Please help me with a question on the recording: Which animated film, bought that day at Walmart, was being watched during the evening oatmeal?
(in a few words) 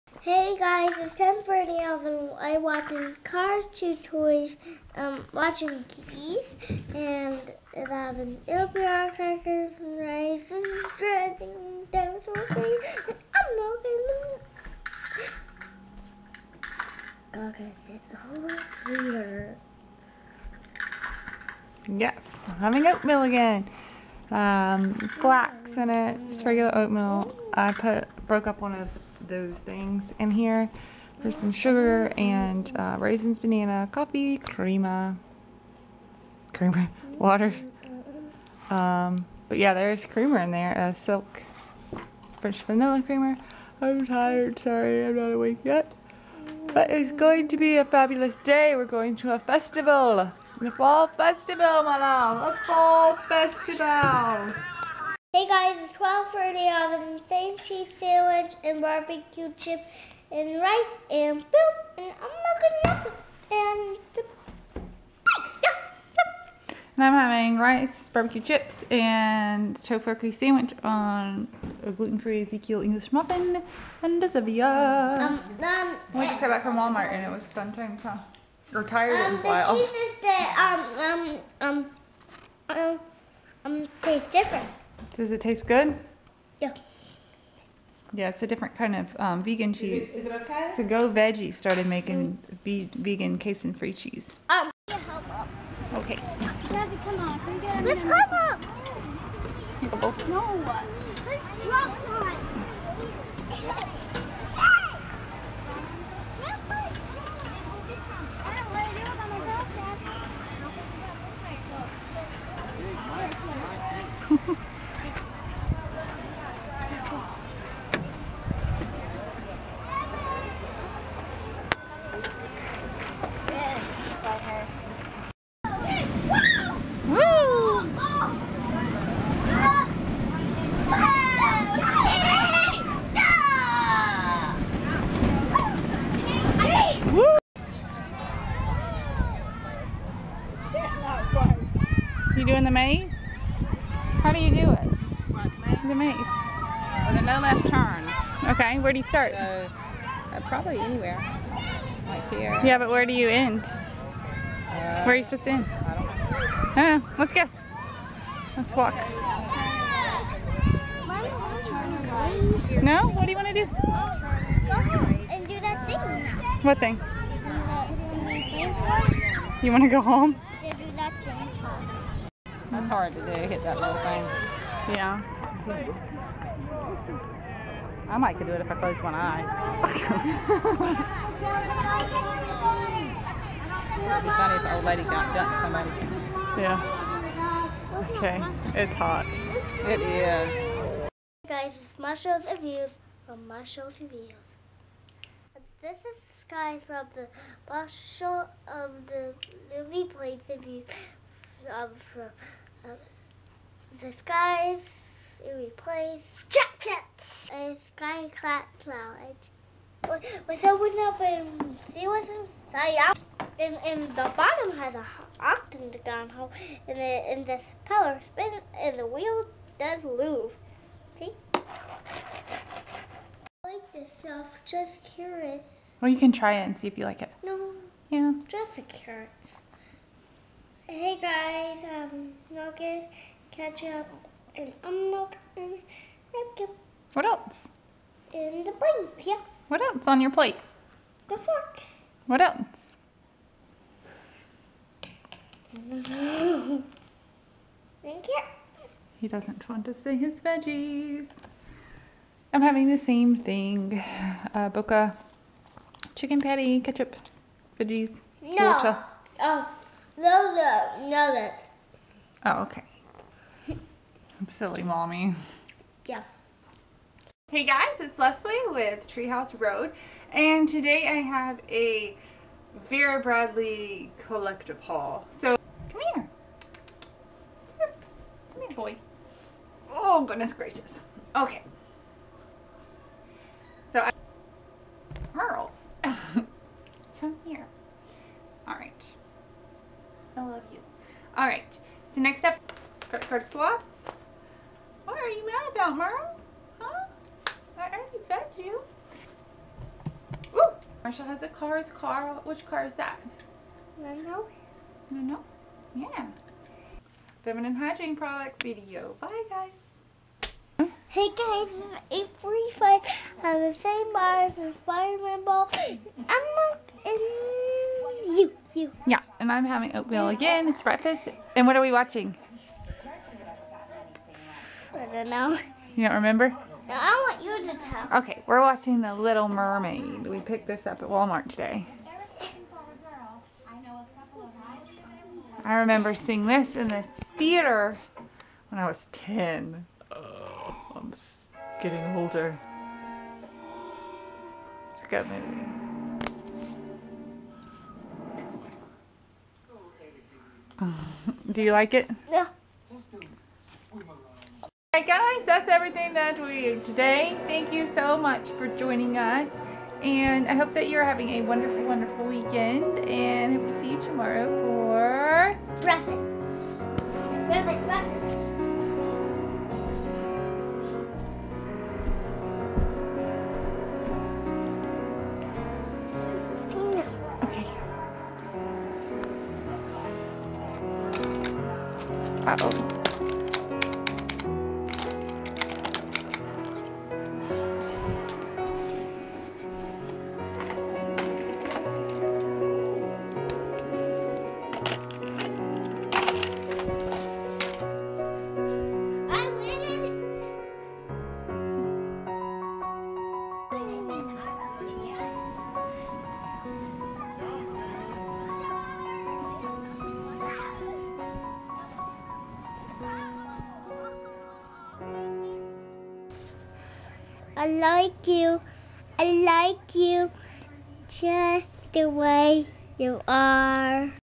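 The Little Mermaid.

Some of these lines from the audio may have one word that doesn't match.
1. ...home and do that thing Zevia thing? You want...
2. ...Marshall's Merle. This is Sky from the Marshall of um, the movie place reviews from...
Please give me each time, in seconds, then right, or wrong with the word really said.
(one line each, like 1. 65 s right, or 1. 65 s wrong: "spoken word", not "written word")
1. 164 s wrong: "What", not "Zevia"
2. 193 s wrong: "Reviews", not "Merle".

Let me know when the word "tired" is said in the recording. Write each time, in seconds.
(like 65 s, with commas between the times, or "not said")
44 s, 78 s.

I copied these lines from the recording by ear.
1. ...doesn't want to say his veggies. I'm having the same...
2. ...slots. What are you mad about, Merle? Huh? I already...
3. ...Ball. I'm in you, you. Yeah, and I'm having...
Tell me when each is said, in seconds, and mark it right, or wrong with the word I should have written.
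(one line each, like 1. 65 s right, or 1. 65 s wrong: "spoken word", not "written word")
1. 249 s right
2. 293 s right
3. 315 s right.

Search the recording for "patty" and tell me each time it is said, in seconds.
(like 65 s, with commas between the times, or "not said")
256 s.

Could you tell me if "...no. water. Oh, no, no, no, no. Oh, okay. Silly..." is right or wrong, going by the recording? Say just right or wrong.
right.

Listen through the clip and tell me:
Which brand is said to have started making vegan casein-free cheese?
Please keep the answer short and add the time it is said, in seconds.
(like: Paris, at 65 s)
Go Veggie, at 90 s.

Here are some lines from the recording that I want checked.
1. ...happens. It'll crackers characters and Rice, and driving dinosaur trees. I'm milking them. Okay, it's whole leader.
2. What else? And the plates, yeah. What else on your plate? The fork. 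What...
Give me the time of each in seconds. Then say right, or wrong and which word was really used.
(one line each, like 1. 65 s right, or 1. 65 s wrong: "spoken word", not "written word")
1. 7 s right
2. 237 s right.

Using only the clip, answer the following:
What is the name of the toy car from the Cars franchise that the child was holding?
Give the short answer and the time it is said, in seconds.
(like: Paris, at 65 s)
Lando, at 303 s.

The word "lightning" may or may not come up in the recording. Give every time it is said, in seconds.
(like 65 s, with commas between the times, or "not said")
not said.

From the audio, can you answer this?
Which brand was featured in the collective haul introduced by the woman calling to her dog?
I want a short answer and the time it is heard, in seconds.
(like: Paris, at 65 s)
Vera Bradley, at 272 s.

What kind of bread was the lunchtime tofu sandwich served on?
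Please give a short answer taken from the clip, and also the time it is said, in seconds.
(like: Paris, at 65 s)
Ezekiel English muffin, at 72 s.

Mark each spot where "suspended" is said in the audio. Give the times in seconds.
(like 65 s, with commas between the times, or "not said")
not said.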